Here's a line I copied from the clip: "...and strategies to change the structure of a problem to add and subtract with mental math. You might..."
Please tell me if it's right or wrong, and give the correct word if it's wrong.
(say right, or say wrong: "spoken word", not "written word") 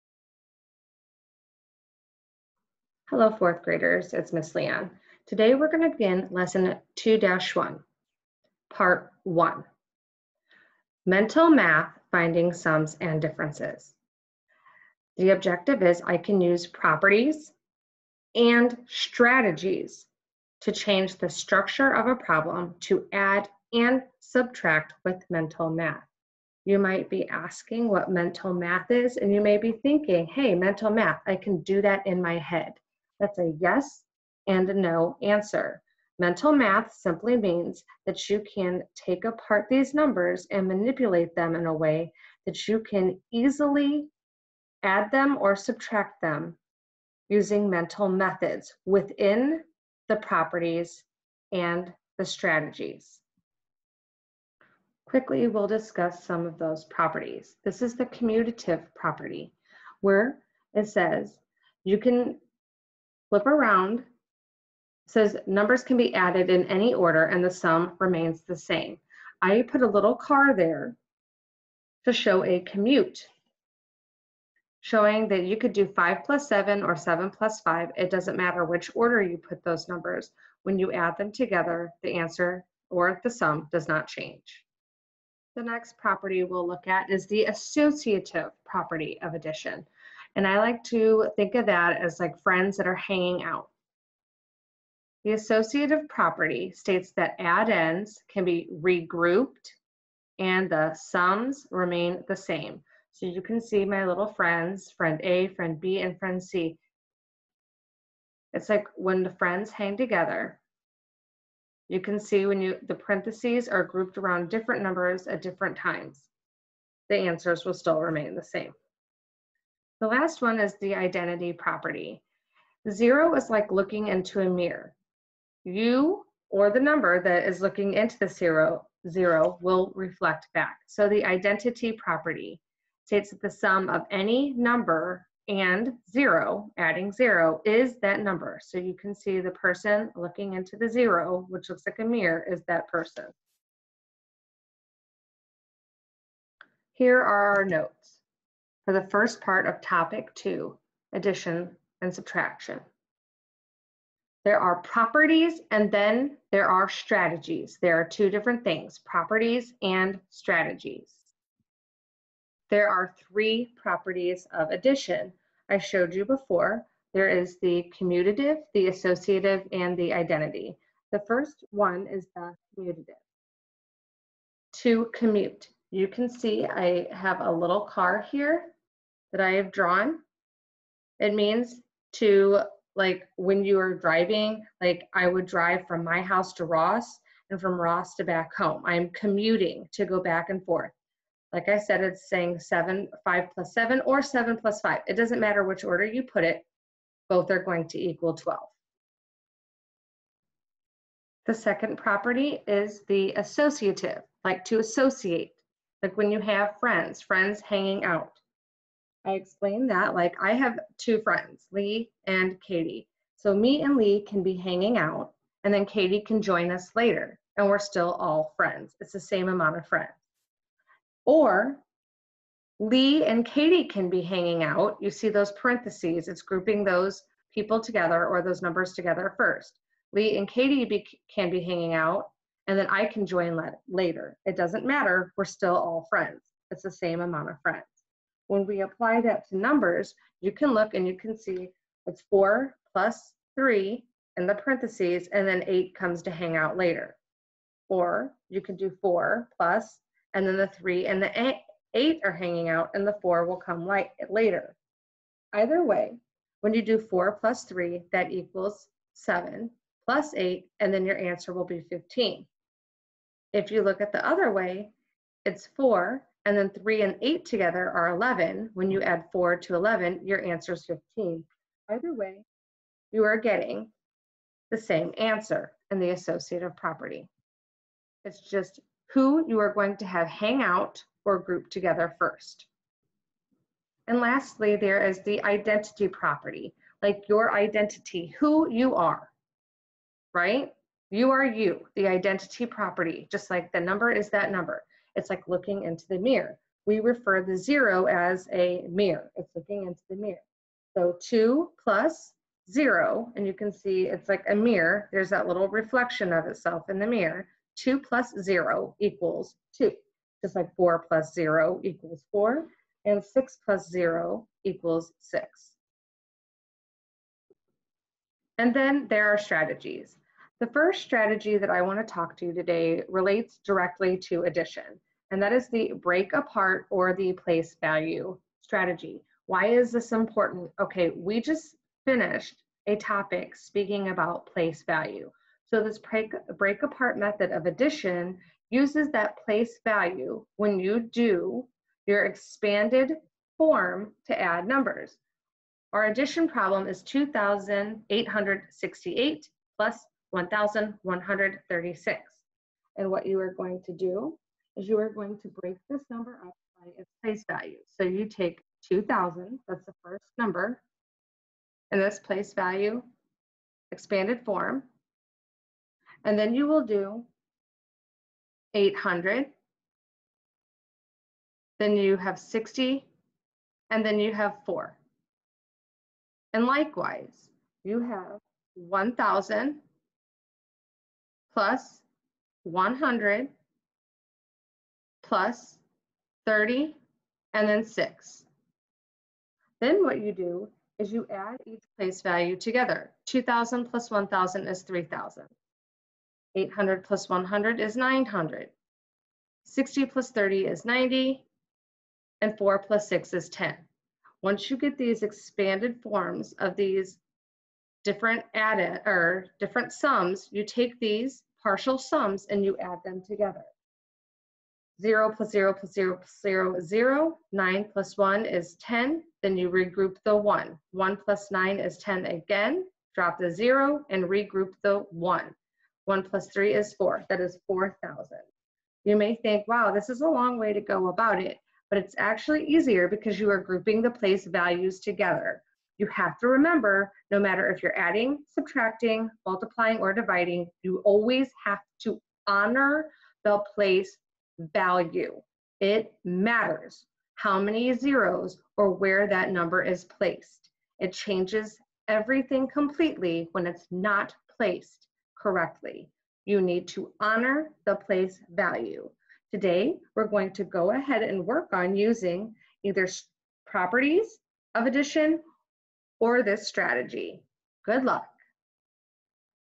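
right.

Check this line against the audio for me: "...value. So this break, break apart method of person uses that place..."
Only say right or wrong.
wrong.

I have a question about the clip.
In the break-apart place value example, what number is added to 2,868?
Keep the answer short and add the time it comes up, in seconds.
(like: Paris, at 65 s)
1,136, at 350 s.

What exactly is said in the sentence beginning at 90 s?
And I like to think of that as like friends that are hanging out.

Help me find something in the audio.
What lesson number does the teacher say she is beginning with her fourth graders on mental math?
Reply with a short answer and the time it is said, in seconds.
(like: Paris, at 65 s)
2-1, at 6 s.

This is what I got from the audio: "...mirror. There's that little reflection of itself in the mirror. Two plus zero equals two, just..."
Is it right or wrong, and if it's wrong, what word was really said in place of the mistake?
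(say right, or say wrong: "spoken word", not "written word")
right.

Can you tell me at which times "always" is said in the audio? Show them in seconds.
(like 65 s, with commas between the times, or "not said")
441 s.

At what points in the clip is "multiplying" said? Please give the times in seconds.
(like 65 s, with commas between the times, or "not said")
439 s.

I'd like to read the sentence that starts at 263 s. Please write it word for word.
If you look at the other way, it's 4, and then 3 and 8 together are 11.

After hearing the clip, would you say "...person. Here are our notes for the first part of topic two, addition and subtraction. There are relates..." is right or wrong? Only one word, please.
wrong.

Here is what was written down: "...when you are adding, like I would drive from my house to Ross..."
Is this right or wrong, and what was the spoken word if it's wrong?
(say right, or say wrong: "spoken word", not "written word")
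wrong: "driving", not "adding".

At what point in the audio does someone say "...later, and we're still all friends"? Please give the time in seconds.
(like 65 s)
216 s.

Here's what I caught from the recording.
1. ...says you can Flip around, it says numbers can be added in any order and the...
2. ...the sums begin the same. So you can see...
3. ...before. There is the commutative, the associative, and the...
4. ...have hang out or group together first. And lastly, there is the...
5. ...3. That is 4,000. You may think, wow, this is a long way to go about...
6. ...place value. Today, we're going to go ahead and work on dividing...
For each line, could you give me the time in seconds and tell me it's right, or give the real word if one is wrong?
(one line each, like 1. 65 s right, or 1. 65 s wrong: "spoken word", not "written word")
1. 60 s right
2. 100 s wrong: "remain", not "begin"
3. 166 s right
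4. 280 s right
5. 426 s wrong: "4", not "3"
6. 457 s wrong: "using", not "dividing".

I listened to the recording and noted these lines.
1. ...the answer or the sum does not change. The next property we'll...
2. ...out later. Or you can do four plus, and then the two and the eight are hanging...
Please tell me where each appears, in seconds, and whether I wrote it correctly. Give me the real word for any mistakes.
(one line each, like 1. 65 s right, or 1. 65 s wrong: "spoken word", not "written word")
1. 82 s right
2. 246 s wrong: "three", not "two".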